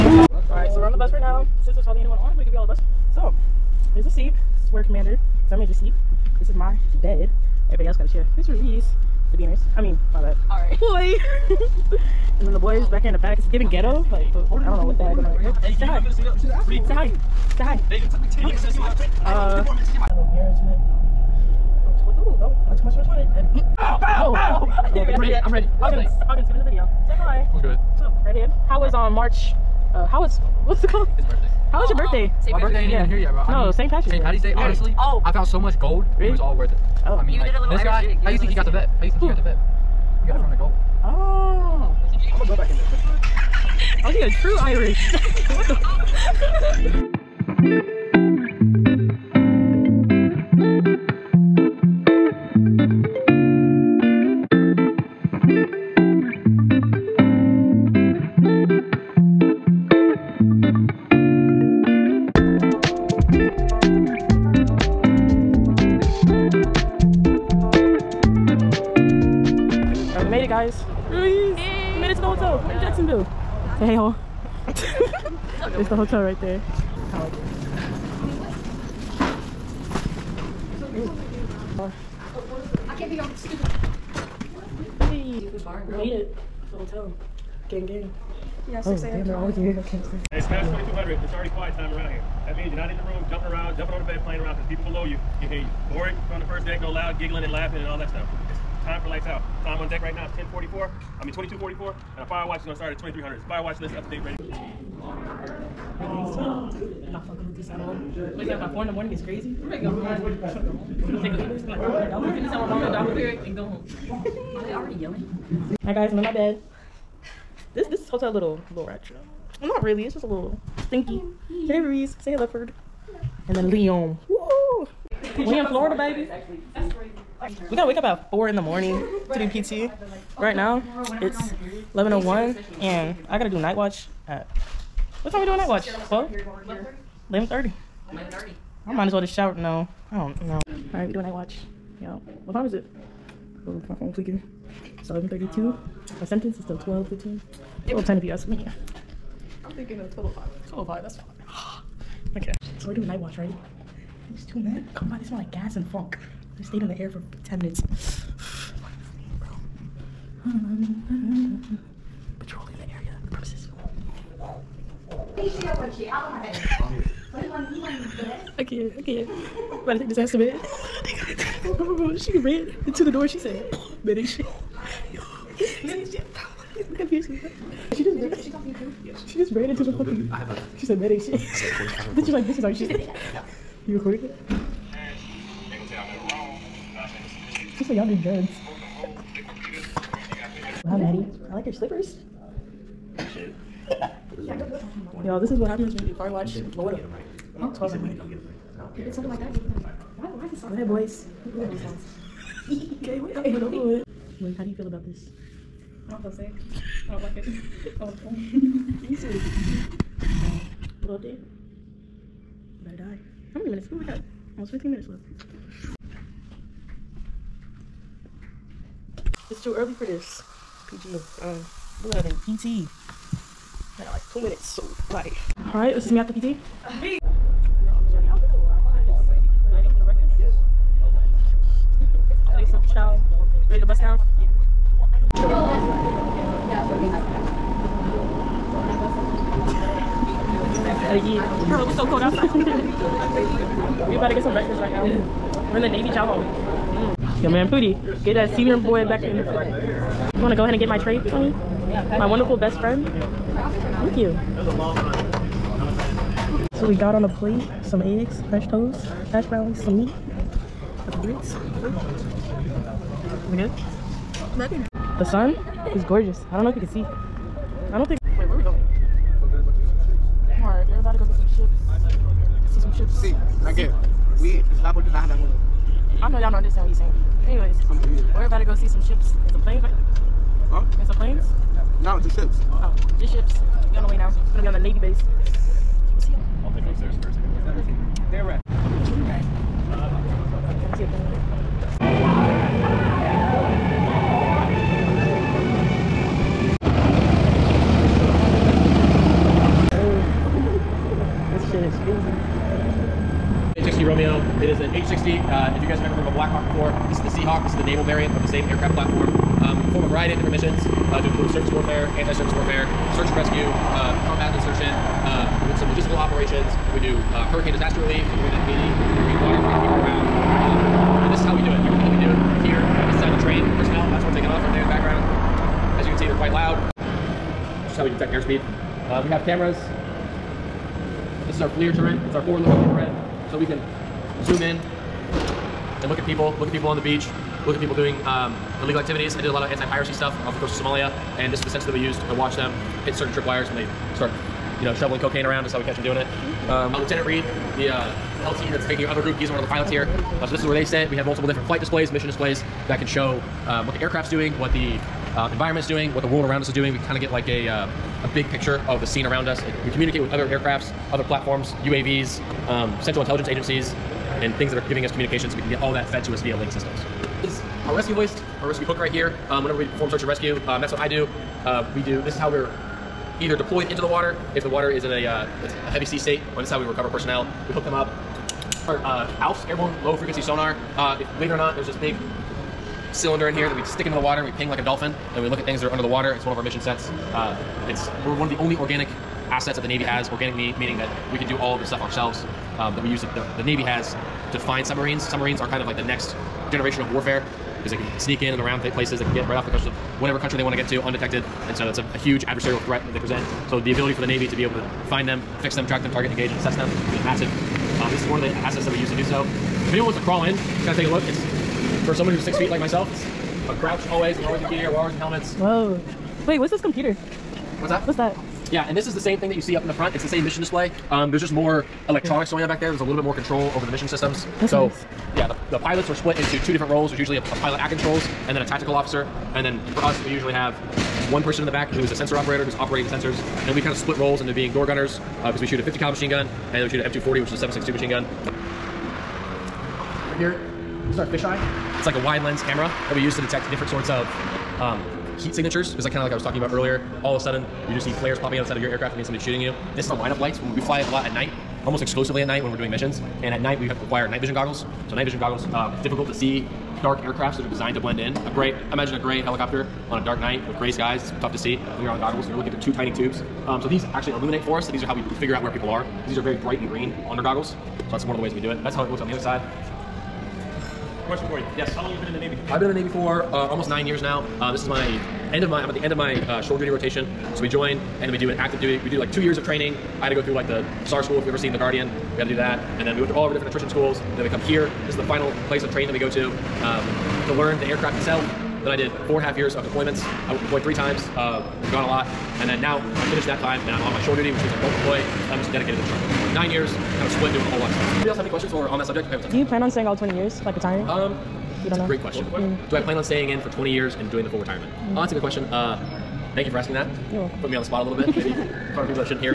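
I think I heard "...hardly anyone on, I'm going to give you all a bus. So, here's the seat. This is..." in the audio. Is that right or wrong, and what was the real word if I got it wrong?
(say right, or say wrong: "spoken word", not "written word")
right.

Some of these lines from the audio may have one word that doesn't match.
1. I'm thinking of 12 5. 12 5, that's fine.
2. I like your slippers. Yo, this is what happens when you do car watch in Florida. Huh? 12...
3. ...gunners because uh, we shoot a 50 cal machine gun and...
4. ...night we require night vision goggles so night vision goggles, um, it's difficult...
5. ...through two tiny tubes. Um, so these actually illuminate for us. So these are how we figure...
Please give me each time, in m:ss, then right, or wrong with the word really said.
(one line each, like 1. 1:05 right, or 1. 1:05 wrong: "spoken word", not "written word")
1. 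2:29 right
2. 3:11 right
3. 7:14 right
4. 7:33 right
5. 7:42 right.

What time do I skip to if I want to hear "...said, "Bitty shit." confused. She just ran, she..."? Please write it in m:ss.
2:53.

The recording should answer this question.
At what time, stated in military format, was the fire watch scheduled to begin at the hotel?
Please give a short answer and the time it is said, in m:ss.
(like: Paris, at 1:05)
2300, at 1:42.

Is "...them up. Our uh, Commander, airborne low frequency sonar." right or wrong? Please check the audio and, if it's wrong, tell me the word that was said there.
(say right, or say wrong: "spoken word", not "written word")
wrong: "ALFS", not "Commander".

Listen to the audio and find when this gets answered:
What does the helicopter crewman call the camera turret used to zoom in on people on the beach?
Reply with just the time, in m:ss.
5:31.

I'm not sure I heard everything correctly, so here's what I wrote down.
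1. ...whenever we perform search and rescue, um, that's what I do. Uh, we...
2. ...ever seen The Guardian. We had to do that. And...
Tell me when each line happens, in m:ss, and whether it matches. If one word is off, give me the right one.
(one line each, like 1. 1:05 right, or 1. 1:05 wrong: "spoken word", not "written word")
1. 6:09 right
2. 8:01 right.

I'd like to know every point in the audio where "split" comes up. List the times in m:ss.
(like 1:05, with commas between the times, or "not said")
7:06, 7:13, 8:17.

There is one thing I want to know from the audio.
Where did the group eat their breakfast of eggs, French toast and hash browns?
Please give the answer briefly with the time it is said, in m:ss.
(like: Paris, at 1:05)
Navy Chow Hall, at 4:05.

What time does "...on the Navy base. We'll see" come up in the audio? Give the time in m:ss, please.
4:44.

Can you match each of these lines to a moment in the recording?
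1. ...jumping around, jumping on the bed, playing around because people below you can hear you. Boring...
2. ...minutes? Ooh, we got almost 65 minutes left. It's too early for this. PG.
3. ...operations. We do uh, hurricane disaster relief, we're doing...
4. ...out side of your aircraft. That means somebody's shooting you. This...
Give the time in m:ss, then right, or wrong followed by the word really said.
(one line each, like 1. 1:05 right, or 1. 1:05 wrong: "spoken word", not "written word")
1. 1:33 right
2. 3:33 wrong: "15", not "65"
3. 5:16 right
4. 7:28 right.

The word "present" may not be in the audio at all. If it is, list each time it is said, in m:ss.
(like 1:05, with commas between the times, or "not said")
6:43.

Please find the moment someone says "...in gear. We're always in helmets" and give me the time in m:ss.
6:54.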